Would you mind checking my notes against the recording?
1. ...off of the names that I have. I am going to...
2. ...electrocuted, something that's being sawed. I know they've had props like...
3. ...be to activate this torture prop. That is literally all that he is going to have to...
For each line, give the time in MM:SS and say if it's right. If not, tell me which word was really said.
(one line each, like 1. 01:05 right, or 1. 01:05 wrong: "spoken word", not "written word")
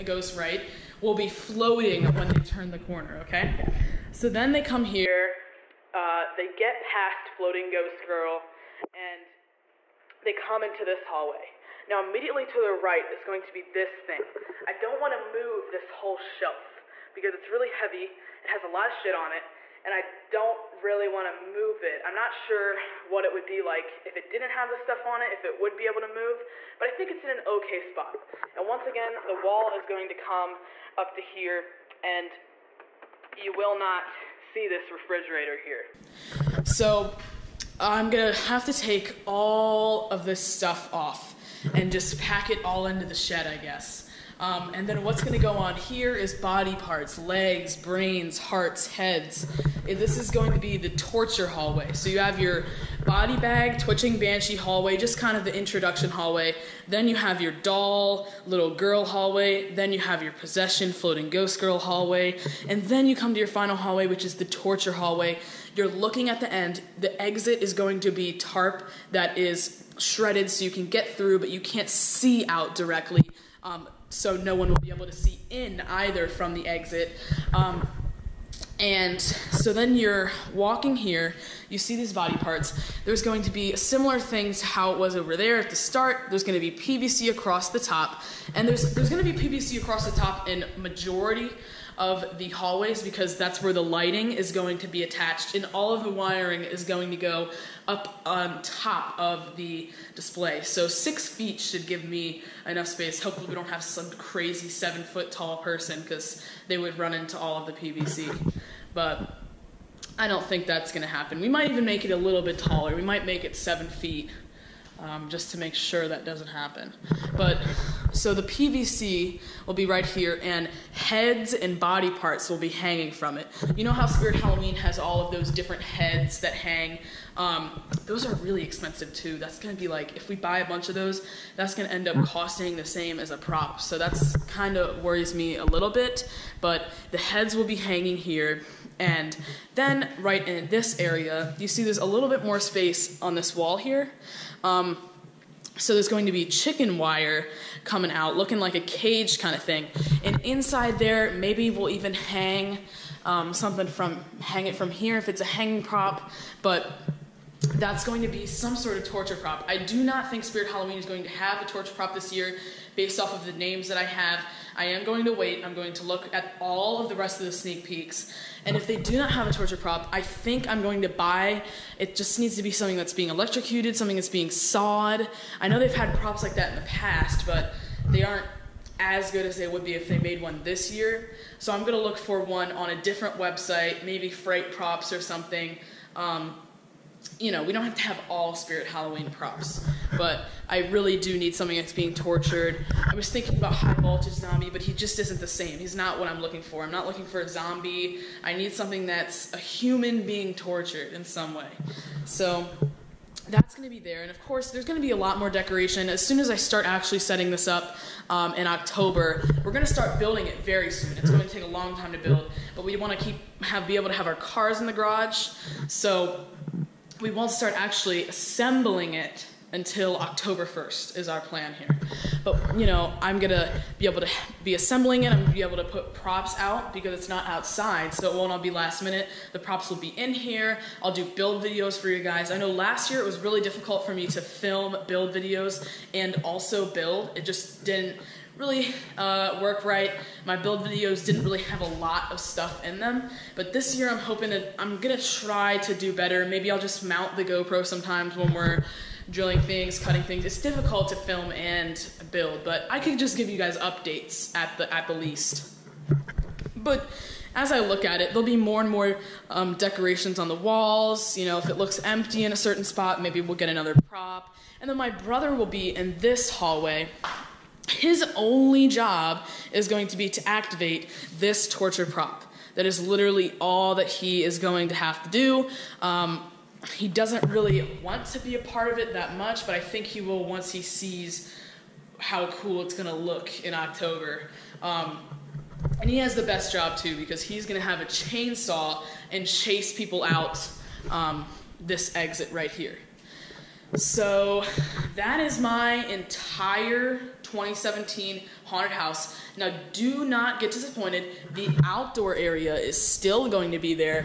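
1. 02:43 right
2. 02:53 right
3. 04:30 right.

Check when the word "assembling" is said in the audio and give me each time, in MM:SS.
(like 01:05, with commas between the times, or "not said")
03:38, 03:44.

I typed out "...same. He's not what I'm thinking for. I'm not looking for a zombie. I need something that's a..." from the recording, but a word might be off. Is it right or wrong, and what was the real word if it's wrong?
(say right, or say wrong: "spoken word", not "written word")
wrong: "looking", not "thinking".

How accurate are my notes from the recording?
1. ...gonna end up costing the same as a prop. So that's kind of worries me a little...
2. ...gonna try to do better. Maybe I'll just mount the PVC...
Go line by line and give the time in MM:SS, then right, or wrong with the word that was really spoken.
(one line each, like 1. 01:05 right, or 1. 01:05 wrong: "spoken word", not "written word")
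1. 02:11 right
2. 04:04 wrong: "GoPro", not "PVC".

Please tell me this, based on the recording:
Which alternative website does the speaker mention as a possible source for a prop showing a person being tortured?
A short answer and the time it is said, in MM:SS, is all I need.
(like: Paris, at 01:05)
Fright Props, at 03:04.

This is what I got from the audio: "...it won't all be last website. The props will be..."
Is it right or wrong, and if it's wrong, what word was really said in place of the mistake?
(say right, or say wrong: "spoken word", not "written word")
wrong: "minute", not "website".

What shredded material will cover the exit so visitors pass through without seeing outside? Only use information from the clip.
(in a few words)
tarp.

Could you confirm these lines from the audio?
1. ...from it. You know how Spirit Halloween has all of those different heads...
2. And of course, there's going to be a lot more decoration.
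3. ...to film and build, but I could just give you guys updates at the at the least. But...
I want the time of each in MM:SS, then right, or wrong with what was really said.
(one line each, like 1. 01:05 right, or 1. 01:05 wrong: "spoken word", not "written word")
1. 02:03 right
2. 03:24 right
3. 04:11 right.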